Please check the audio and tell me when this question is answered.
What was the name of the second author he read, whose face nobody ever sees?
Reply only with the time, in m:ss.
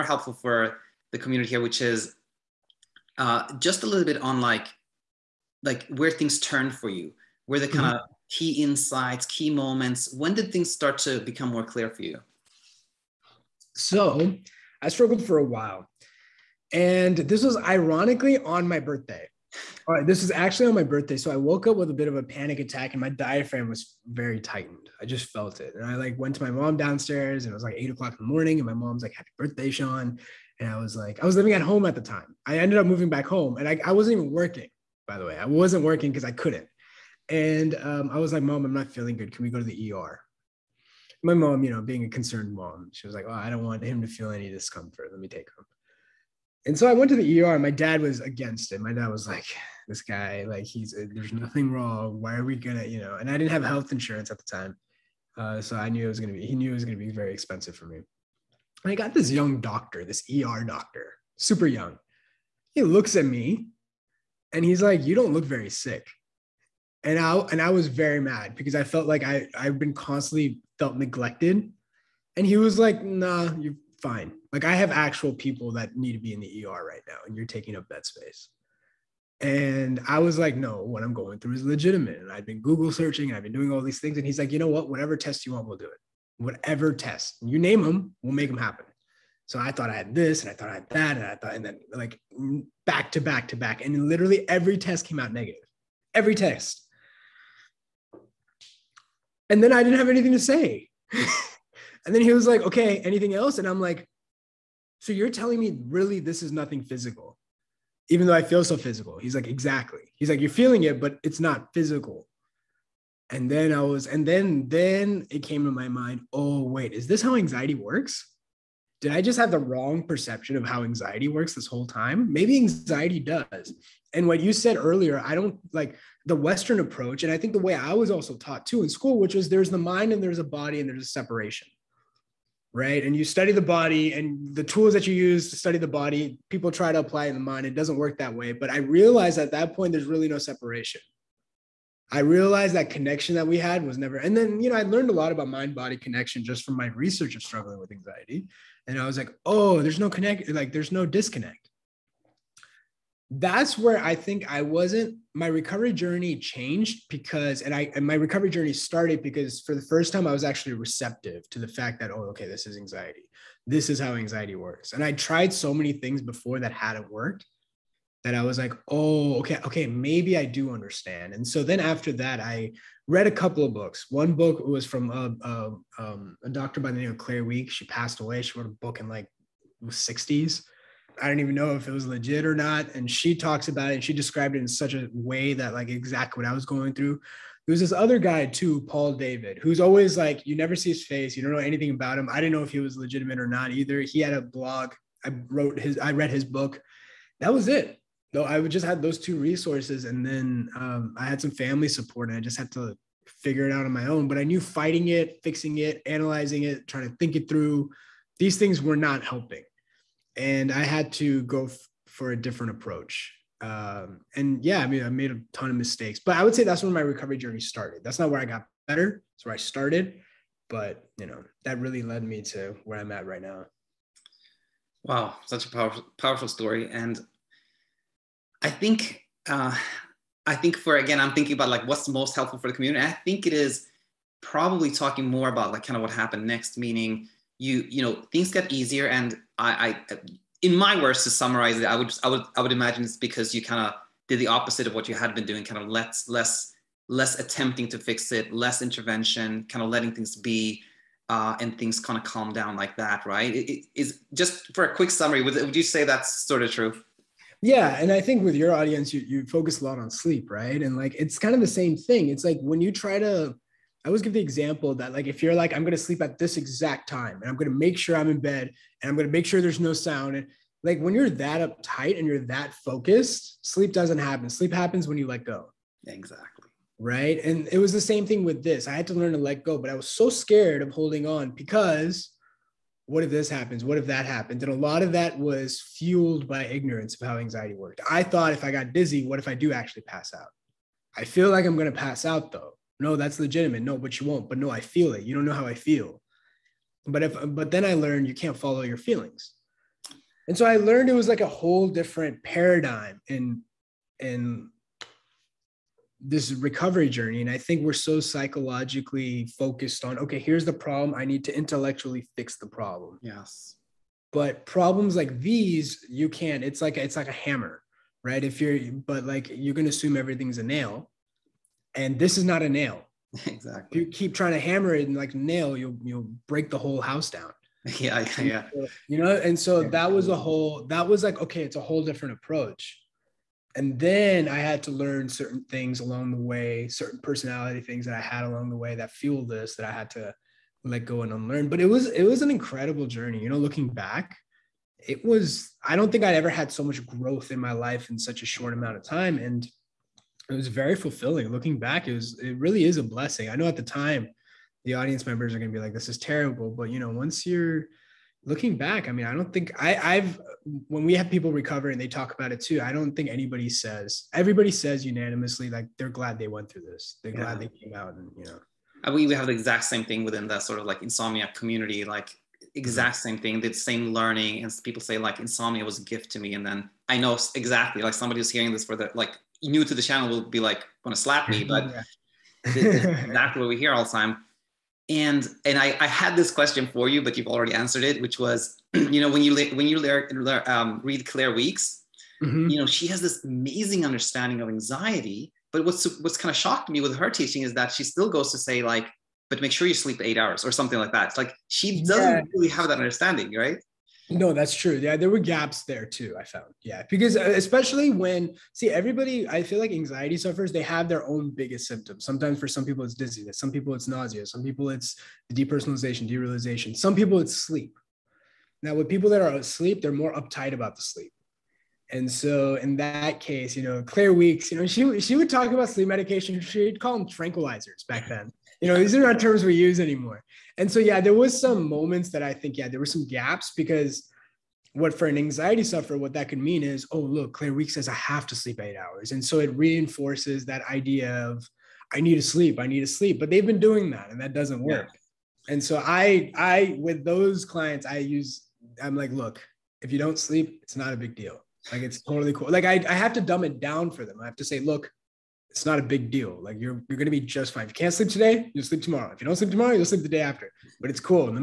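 3:08.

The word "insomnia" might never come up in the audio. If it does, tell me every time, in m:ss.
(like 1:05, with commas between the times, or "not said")
6:11, 6:15.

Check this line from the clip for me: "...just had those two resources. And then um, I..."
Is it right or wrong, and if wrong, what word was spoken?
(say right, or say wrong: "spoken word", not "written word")
right.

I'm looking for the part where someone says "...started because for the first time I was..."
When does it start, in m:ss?
2:38.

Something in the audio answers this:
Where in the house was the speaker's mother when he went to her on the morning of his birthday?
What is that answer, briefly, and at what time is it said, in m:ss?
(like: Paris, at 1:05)
Downstairs, at 0:26.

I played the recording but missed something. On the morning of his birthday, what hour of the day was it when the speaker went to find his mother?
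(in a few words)
8 o'clock.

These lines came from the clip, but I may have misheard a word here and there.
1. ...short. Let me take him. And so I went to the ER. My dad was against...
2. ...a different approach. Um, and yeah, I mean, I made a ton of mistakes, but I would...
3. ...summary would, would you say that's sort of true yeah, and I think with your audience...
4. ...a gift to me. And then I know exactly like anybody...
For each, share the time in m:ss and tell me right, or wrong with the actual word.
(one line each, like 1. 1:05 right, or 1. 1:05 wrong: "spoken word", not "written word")
1. 0:44 wrong: "discomfort", not "short"
2. 3:32 right
3. 4:15 right
4. 6:15 wrong: "somebody", not "anybody".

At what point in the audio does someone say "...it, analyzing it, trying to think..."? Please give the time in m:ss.
3:25.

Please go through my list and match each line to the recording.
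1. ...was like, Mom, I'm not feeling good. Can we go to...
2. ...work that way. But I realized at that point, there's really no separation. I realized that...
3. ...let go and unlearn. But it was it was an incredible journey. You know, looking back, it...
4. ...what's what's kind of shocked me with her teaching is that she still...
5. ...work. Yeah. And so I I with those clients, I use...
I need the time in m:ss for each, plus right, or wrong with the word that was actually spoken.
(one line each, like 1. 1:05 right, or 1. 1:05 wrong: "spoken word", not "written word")
1. 0:38 right
2. 2:17 right
3. 5:40 right
4. 6:35 right
5. 7:24 right.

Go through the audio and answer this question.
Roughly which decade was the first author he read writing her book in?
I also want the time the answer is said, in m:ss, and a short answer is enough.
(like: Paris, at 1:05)
The 60s, at 2:59.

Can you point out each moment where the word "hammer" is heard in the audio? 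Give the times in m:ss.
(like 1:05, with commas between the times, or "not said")
5:17, 5:24.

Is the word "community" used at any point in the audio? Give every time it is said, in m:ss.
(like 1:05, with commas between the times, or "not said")
0:01, 3:52, 6:11.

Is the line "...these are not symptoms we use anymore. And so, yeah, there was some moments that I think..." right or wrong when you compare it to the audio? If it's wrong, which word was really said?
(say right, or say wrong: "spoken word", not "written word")
wrong: "terms", not "symptoms".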